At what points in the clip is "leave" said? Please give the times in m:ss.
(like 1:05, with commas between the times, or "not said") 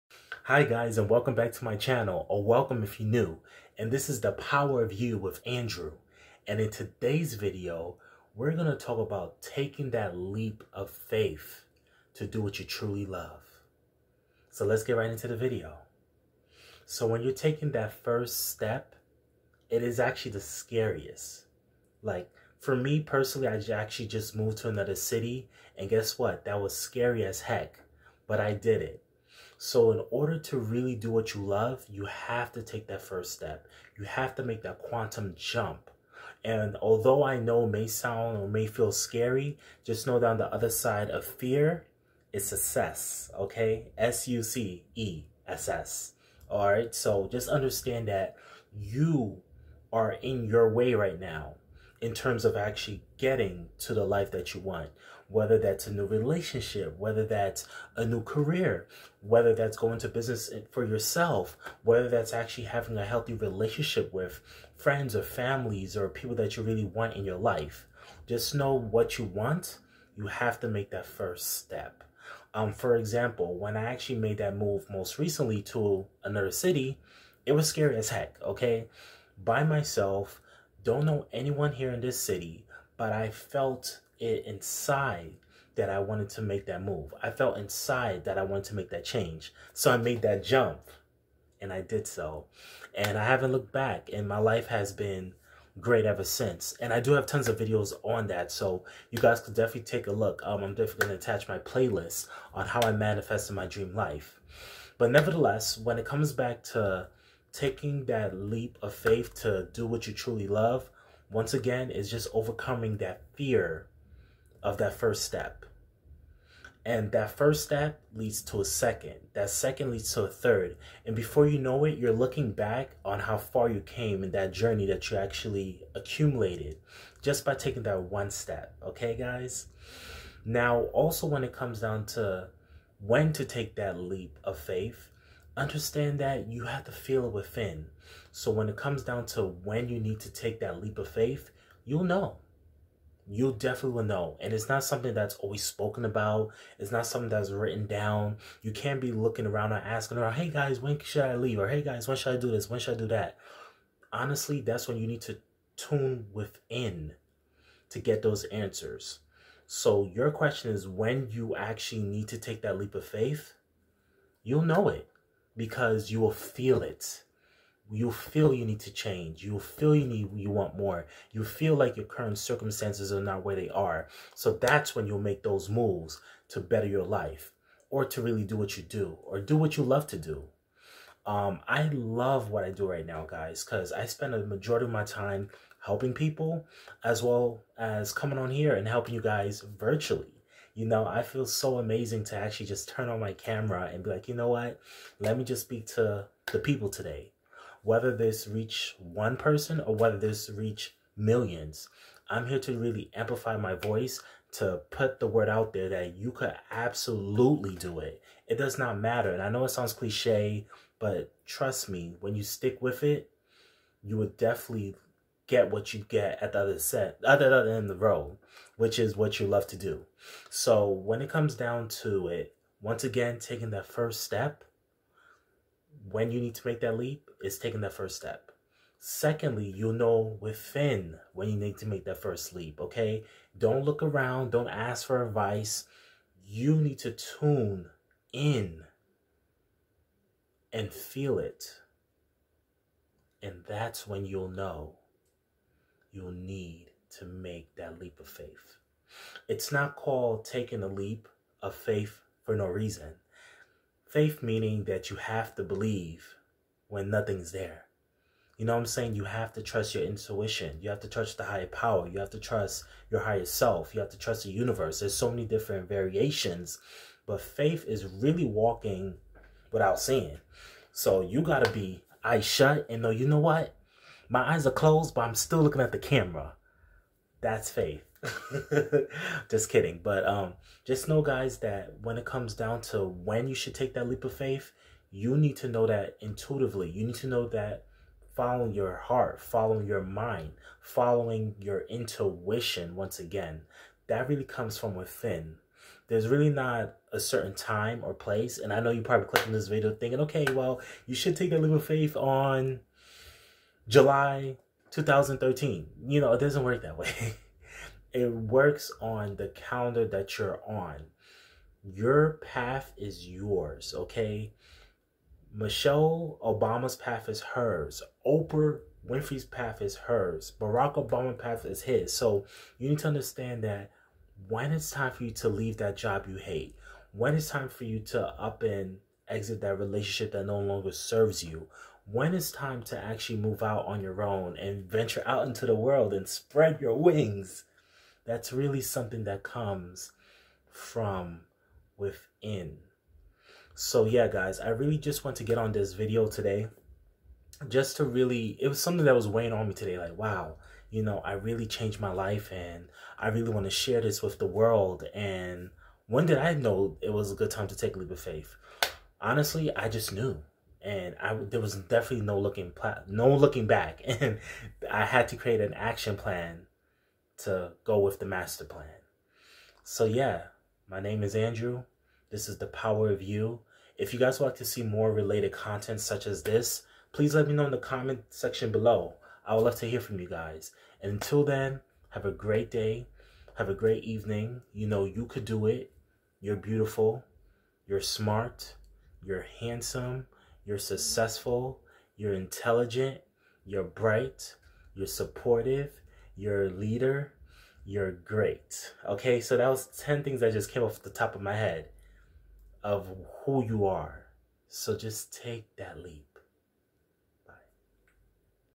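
2:31, 5:25.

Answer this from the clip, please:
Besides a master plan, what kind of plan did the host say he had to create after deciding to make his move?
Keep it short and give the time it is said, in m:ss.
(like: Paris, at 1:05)
an action plan, at 6:05.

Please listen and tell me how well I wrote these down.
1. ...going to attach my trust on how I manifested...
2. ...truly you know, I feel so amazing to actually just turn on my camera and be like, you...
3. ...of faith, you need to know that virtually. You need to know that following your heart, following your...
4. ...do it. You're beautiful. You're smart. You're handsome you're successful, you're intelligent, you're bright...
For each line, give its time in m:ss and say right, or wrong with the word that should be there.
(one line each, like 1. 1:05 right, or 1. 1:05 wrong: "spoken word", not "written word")
1. 1:41 wrong: "playlist", not "trust"
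2. 3:09 wrong: "virtually", not "truly"
3. 4:44 wrong: "intuitively", not "virtually"
4. 6:25 right.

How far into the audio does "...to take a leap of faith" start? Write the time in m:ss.
5:57.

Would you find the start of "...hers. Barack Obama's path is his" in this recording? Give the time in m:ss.
5:19.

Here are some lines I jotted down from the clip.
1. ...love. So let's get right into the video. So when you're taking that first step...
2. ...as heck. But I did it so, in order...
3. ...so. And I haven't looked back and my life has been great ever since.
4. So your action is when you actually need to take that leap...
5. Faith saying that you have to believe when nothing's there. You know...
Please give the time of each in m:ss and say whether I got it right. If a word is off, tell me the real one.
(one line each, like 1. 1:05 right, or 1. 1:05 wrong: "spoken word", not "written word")
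1. 0:13 right
2. 0:27 right
3. 1:32 right
4. 2:39 wrong: "question", not "action"
5. 4:14 wrong: "meaning", not "saying".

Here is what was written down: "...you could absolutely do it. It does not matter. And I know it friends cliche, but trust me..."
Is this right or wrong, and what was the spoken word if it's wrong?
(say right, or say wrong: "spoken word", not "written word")
wrong: "sounds", not "friends".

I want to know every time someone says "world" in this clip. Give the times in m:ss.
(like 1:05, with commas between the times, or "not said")
5:35, 5:54.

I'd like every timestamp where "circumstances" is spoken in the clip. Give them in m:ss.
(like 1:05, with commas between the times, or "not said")
2:52.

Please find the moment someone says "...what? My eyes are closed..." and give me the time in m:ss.
4:33.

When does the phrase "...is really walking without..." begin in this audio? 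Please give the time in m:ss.
4:27.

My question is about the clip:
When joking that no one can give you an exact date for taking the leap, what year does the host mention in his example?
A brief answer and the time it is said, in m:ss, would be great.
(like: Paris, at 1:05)
2013, at 5:04.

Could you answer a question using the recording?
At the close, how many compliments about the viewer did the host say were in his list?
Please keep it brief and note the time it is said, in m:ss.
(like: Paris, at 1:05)
10, at 6:39.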